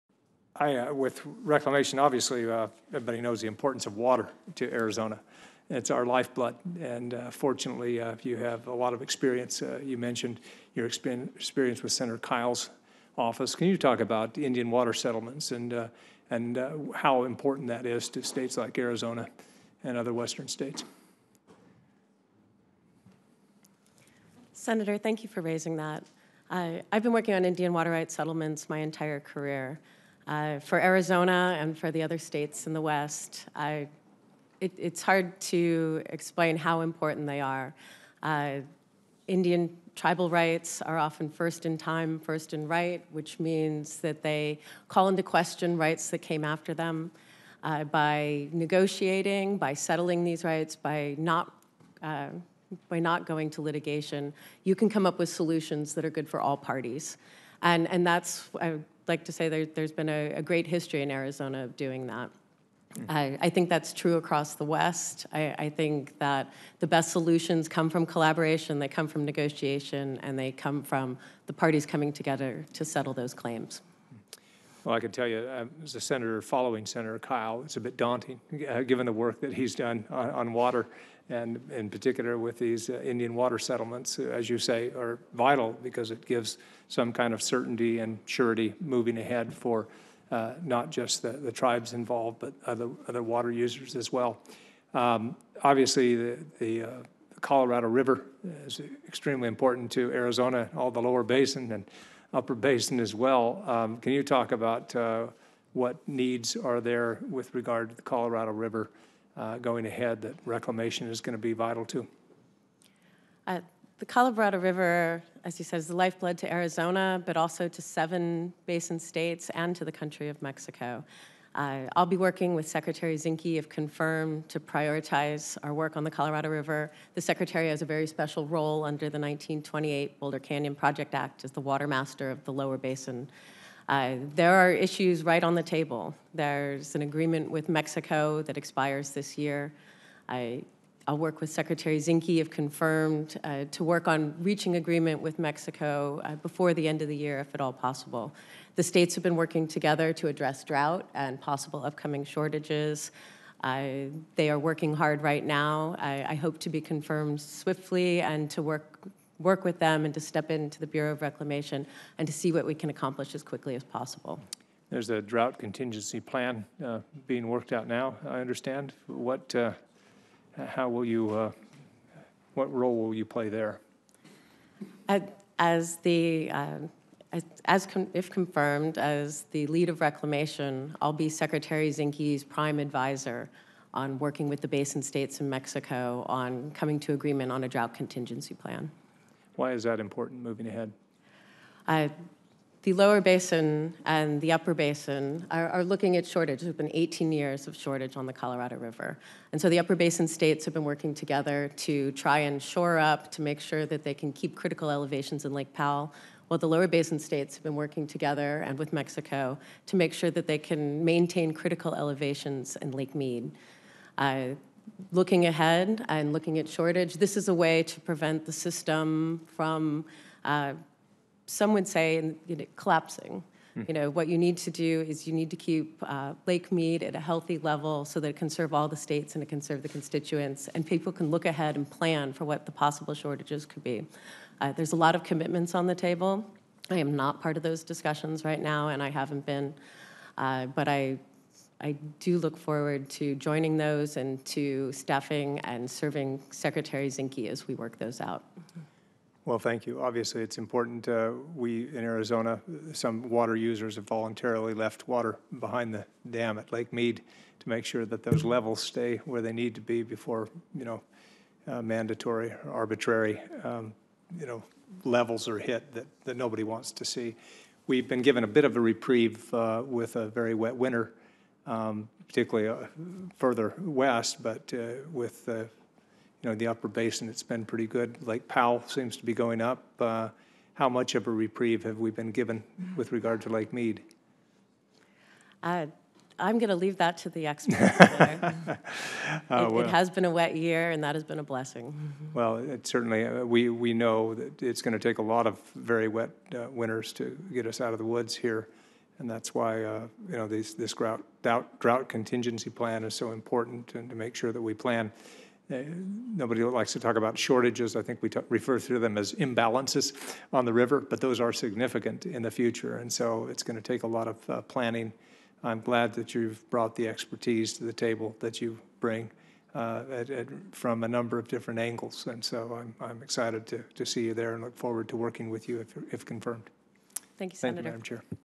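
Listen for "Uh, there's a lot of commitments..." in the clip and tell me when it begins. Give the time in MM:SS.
03:54.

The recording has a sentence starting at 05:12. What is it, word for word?
And so it's going to take a lot of uh, planning.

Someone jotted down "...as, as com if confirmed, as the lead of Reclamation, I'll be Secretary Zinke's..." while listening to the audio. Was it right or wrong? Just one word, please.
right.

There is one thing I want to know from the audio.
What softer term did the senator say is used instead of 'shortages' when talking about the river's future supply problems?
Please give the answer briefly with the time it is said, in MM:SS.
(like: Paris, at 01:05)
imbalances, at 05:09.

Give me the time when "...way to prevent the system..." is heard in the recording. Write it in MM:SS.
03:37.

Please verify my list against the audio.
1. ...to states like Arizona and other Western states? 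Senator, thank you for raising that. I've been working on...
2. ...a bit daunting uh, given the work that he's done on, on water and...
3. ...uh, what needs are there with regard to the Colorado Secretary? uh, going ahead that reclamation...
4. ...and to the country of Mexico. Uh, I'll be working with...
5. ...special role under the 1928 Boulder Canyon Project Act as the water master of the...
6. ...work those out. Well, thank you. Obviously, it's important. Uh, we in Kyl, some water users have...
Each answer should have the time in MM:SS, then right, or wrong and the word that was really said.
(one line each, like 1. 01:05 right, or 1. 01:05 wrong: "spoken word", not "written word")
1. 00:18 right
2. 01:17 right
3. 01:44 wrong: "River", not "Secretary"
4. 01:59 right
5. 02:08 right
6. 04:07 wrong: "Arizona", not "Kyl".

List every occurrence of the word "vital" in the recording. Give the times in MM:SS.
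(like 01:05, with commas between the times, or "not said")
01:25, 01:51.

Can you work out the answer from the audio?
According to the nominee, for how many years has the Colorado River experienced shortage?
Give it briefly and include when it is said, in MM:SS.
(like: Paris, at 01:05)
18 years, at 03:16.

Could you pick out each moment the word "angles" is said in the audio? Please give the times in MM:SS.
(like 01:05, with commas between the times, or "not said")
05:21.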